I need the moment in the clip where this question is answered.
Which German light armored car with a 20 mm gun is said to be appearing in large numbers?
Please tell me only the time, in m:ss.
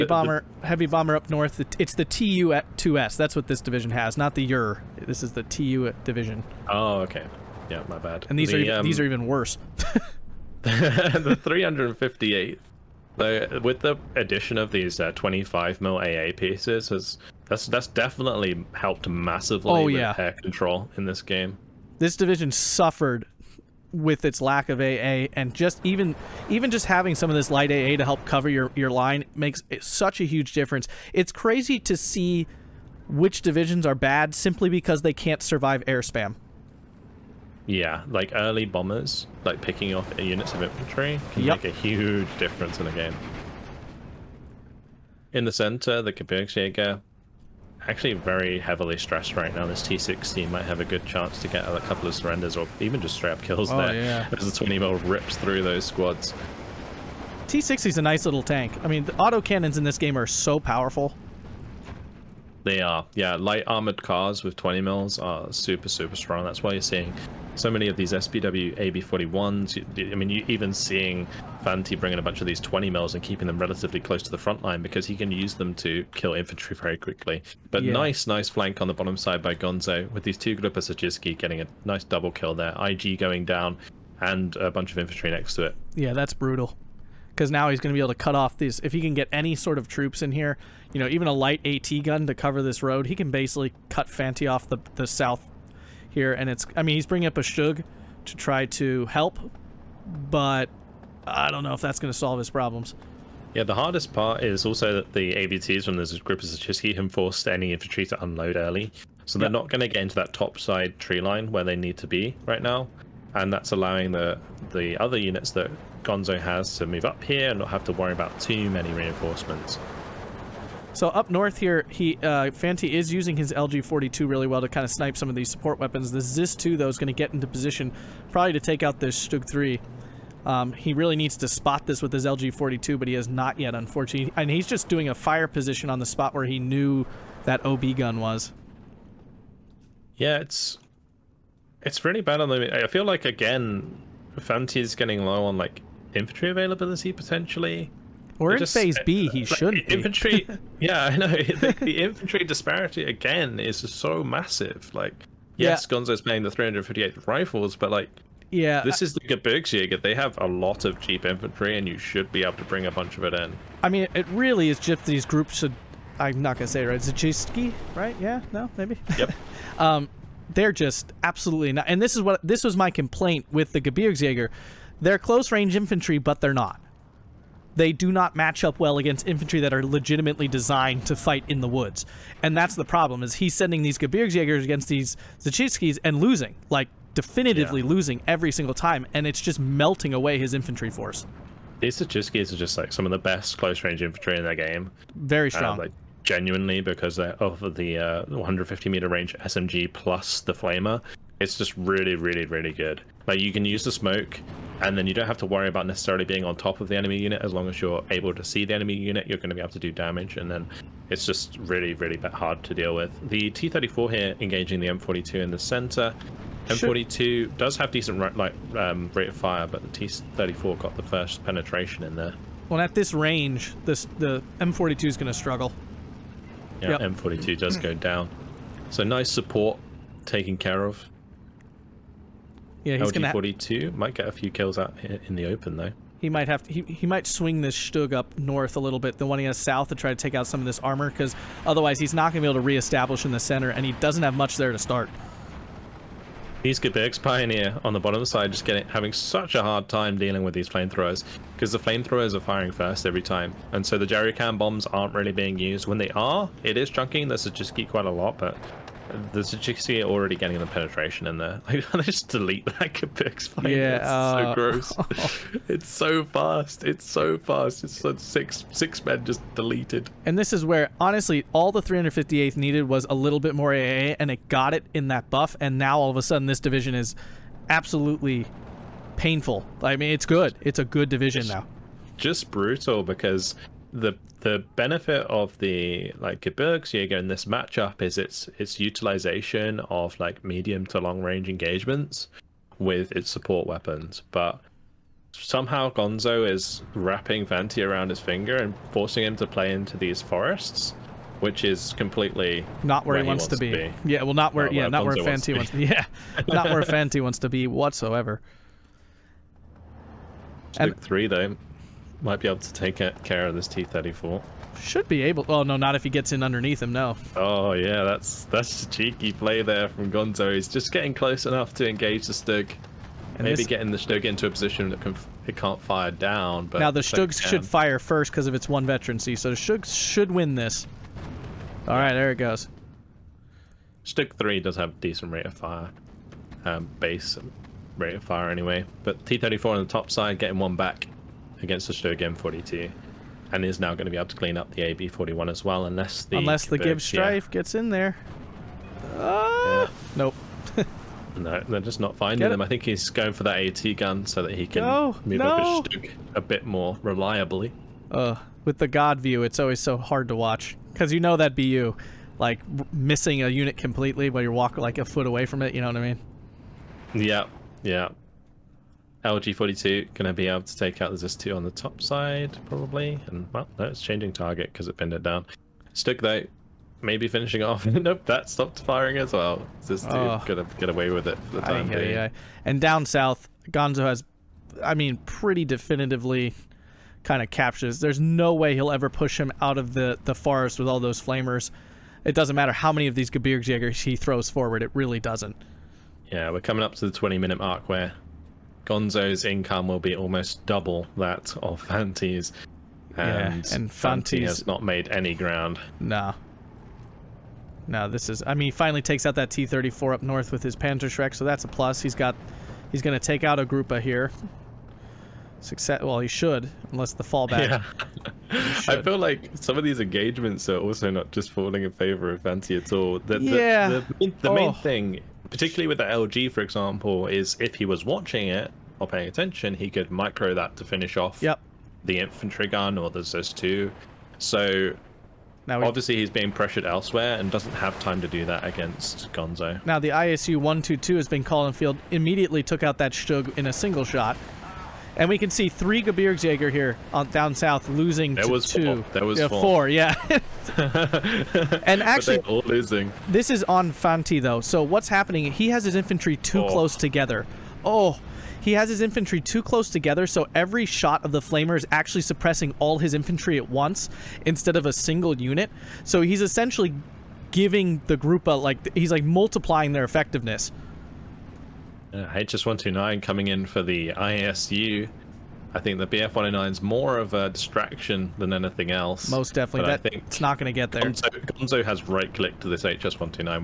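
1:08.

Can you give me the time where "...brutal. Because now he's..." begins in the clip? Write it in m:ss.
1:26.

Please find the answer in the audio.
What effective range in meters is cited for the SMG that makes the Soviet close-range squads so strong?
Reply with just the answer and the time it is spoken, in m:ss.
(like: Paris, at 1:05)
150, at 3:18.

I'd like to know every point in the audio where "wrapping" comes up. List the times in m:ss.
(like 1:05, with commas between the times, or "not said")
4:56.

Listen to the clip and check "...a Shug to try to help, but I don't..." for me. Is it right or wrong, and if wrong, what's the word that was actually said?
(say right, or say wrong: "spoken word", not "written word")
right.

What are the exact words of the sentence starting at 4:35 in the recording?
And now all of a sudden, this division is absolutely painful.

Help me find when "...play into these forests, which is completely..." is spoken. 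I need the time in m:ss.
4:59.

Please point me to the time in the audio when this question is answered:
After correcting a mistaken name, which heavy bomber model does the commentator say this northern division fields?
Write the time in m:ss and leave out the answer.
0:02.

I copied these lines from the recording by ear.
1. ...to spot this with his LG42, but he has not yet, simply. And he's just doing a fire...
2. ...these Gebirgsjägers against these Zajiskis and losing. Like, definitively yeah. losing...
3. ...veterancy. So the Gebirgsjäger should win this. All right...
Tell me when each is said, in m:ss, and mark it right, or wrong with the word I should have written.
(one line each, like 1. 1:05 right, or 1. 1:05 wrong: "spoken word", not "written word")
1. 2:11 wrong: "unfortunately", not "simply"
2. 3:03 right
3. 5:28 wrong: "Stug", not "Gebirgsjäger".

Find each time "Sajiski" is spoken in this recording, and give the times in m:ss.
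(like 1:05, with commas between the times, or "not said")
1:20, 3:11.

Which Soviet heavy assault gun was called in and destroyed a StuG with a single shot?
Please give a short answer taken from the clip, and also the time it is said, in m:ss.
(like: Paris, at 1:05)
ISU 122, at 7:20.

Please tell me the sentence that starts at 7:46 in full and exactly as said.
So he's essentially giving the Grupa like he's like multiplying their effectiveness.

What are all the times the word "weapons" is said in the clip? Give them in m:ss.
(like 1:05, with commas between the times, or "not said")
2:05, 4:53.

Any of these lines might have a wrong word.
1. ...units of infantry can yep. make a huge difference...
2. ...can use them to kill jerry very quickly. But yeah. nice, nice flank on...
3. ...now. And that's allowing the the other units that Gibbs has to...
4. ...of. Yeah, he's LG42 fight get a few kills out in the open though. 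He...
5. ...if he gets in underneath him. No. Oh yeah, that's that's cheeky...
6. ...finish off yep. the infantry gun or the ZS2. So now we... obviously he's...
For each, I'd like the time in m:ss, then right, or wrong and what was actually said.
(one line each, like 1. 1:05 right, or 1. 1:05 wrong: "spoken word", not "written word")
1. 0:40 right
2. 1:15 wrong: "infantry", not "jerry"
3. 1:52 wrong: "Gonzo", not "Gibbs"
4. 3:50 wrong: "might", not "fight"
5. 5:15 right
6. 7:10 right.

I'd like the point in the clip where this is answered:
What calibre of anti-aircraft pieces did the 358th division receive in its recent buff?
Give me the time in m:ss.
0:15.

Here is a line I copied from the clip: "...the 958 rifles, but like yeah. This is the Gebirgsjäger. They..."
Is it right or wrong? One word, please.
wrong.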